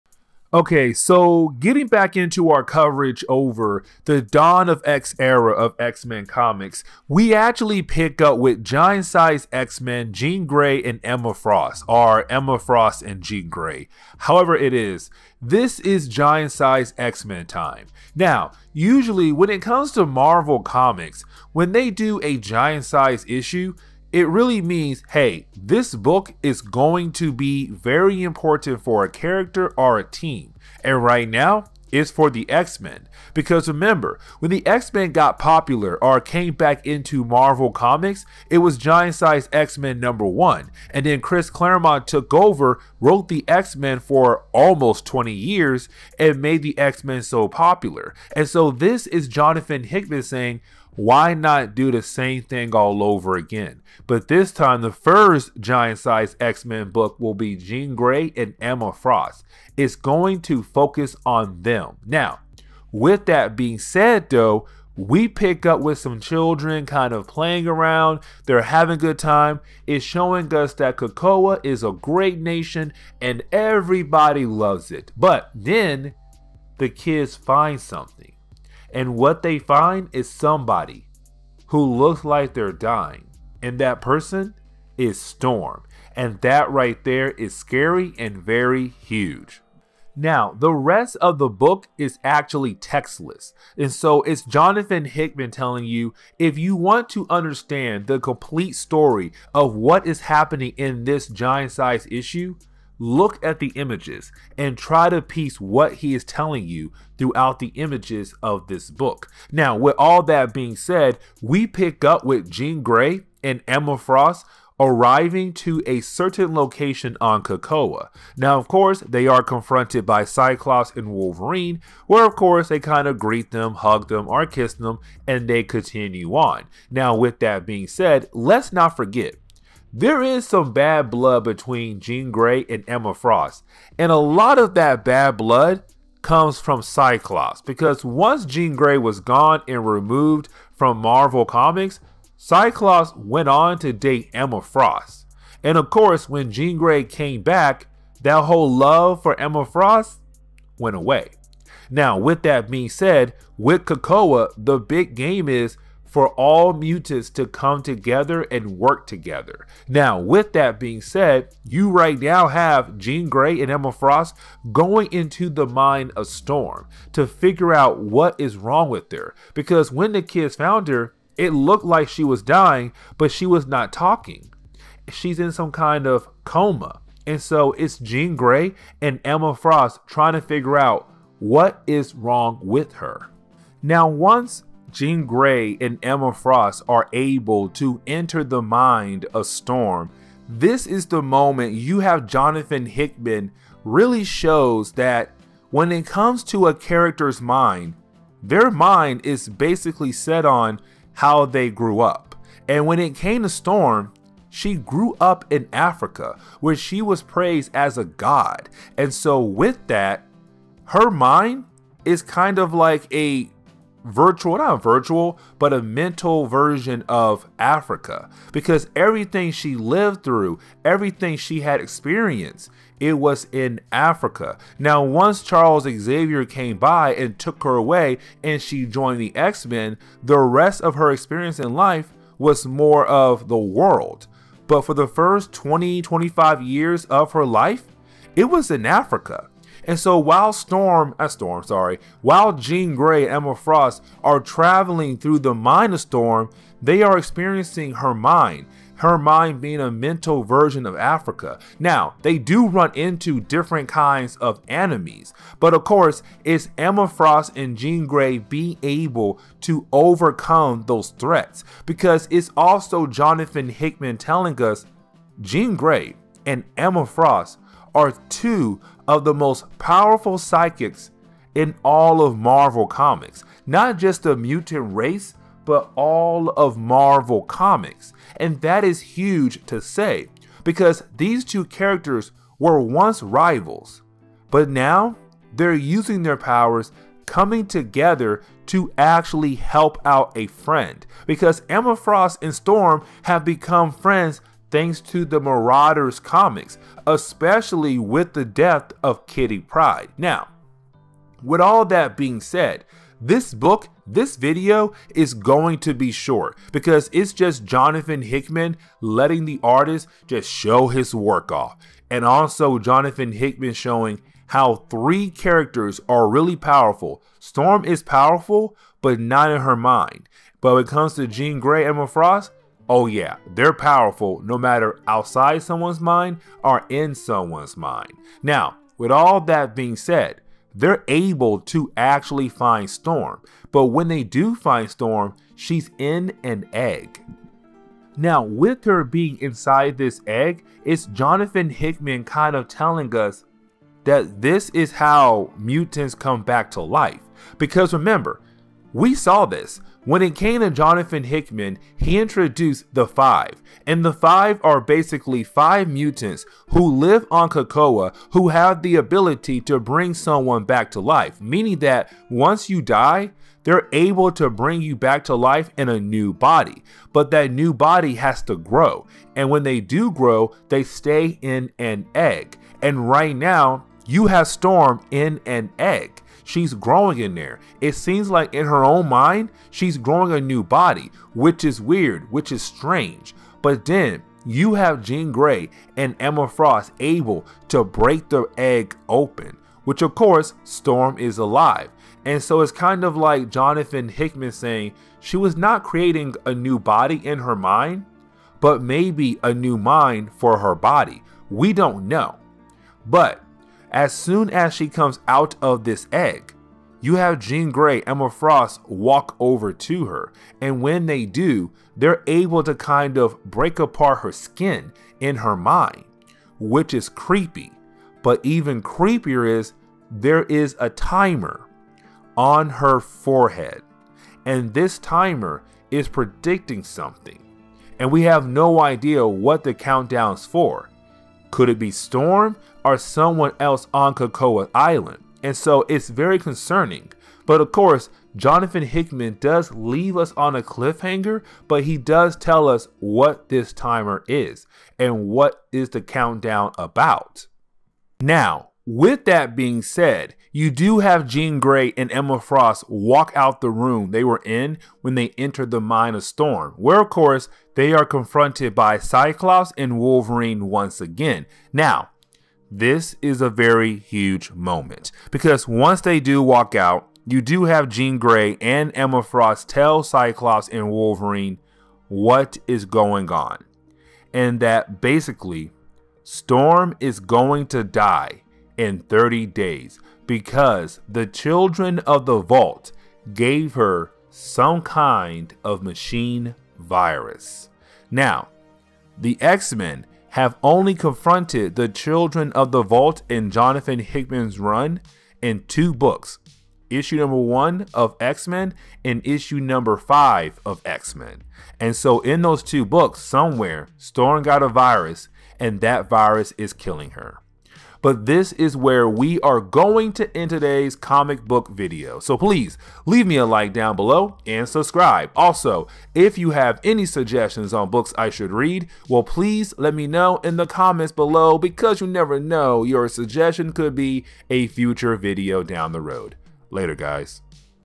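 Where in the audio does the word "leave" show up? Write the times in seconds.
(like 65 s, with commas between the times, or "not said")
439 s, 513 s.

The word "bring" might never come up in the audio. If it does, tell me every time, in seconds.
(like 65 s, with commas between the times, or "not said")
359 s, 364 s.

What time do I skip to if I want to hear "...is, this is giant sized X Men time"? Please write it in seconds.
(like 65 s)
14 s.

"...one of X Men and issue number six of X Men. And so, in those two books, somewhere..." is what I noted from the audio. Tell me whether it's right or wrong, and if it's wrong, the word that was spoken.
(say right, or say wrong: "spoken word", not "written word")
wrong: "five", not "six".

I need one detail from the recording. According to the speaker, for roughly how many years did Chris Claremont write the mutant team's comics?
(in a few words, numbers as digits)
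almost 20 years.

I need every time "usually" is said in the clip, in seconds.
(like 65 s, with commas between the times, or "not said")
18 s.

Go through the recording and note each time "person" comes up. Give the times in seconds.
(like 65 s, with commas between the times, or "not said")
84 s.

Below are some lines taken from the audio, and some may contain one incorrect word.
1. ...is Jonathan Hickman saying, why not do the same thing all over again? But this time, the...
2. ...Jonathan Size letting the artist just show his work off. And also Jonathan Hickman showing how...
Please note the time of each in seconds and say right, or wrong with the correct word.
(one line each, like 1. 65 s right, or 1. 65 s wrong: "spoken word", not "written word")
1. 49 s right
2. 307 s wrong: "Hickman", not "Size".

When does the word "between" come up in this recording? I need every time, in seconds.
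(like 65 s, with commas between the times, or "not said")
131 s.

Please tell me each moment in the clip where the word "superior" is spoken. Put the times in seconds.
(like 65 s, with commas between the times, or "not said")
not said.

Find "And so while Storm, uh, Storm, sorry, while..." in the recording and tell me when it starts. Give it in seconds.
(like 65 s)
239 s.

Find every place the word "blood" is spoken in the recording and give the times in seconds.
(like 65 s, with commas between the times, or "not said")
131 s, 135 s.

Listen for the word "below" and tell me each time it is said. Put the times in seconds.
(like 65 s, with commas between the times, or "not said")
513 s, 521 s.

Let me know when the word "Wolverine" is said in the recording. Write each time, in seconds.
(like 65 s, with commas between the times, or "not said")
121 s, 459 s, 470 s.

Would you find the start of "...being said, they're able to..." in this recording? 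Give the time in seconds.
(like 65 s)
329 s.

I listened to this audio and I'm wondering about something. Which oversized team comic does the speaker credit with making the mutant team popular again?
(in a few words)
Giant Size X Men number one.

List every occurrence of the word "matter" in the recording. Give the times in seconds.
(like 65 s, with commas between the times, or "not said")
324 s.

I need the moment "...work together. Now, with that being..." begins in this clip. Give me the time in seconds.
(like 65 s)
158 s.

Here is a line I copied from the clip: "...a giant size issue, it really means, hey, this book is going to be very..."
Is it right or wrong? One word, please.
right.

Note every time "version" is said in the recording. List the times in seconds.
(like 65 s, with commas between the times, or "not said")
216 s, 250 s.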